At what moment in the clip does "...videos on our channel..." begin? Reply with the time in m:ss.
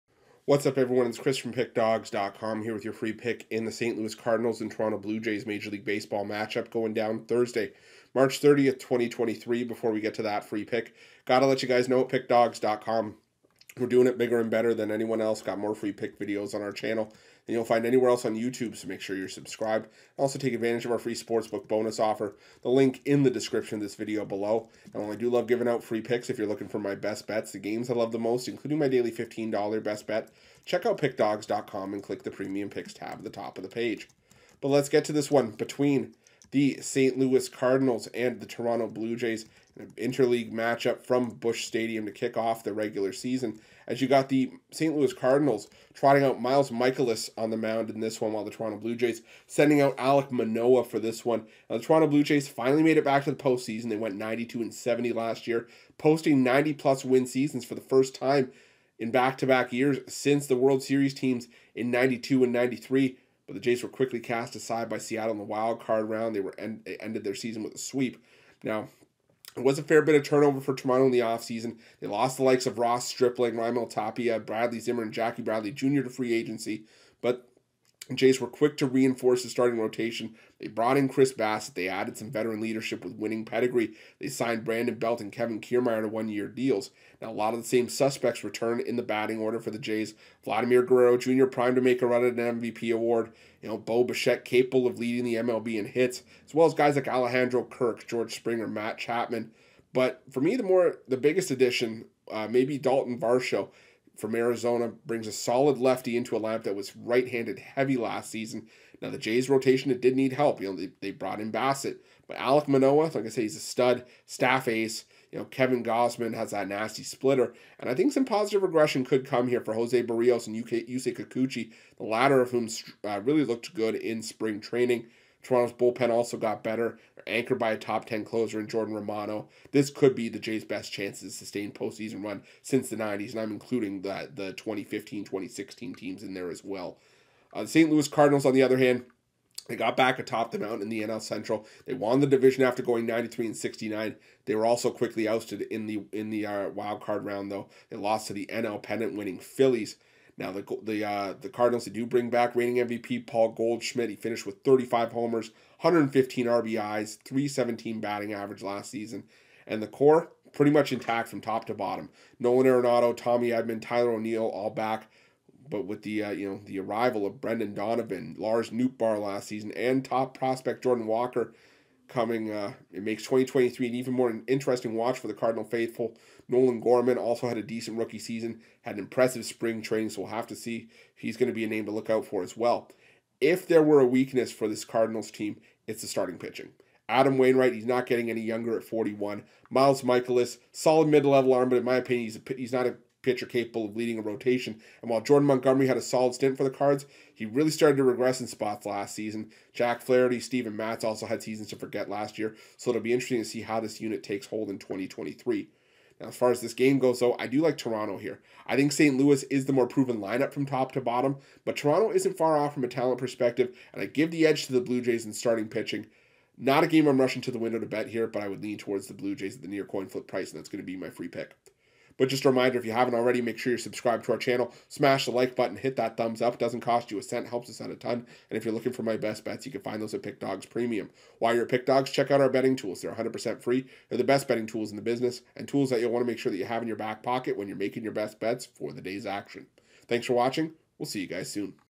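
0:16.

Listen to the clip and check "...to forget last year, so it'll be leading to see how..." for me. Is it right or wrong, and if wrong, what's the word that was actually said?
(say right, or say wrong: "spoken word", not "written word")
wrong: "interesting", not "leading".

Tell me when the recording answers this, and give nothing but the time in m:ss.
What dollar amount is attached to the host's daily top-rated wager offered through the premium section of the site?
0:29.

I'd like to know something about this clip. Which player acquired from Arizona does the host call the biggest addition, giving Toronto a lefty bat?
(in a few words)
Dalton Varsho.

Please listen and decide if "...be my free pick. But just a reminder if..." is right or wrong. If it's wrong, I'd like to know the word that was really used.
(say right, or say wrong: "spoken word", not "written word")
right.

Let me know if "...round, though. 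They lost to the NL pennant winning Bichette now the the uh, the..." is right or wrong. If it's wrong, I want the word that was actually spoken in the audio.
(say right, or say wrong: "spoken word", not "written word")
wrong: "Phillies", not "Bichette".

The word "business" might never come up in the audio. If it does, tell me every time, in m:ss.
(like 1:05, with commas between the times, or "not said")
3:55.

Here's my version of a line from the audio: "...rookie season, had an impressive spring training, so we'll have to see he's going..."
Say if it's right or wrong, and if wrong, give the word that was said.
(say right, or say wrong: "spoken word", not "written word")
right.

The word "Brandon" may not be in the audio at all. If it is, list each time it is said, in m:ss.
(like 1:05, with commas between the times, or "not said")
1:24.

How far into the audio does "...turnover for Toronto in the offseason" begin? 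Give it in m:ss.
1:10.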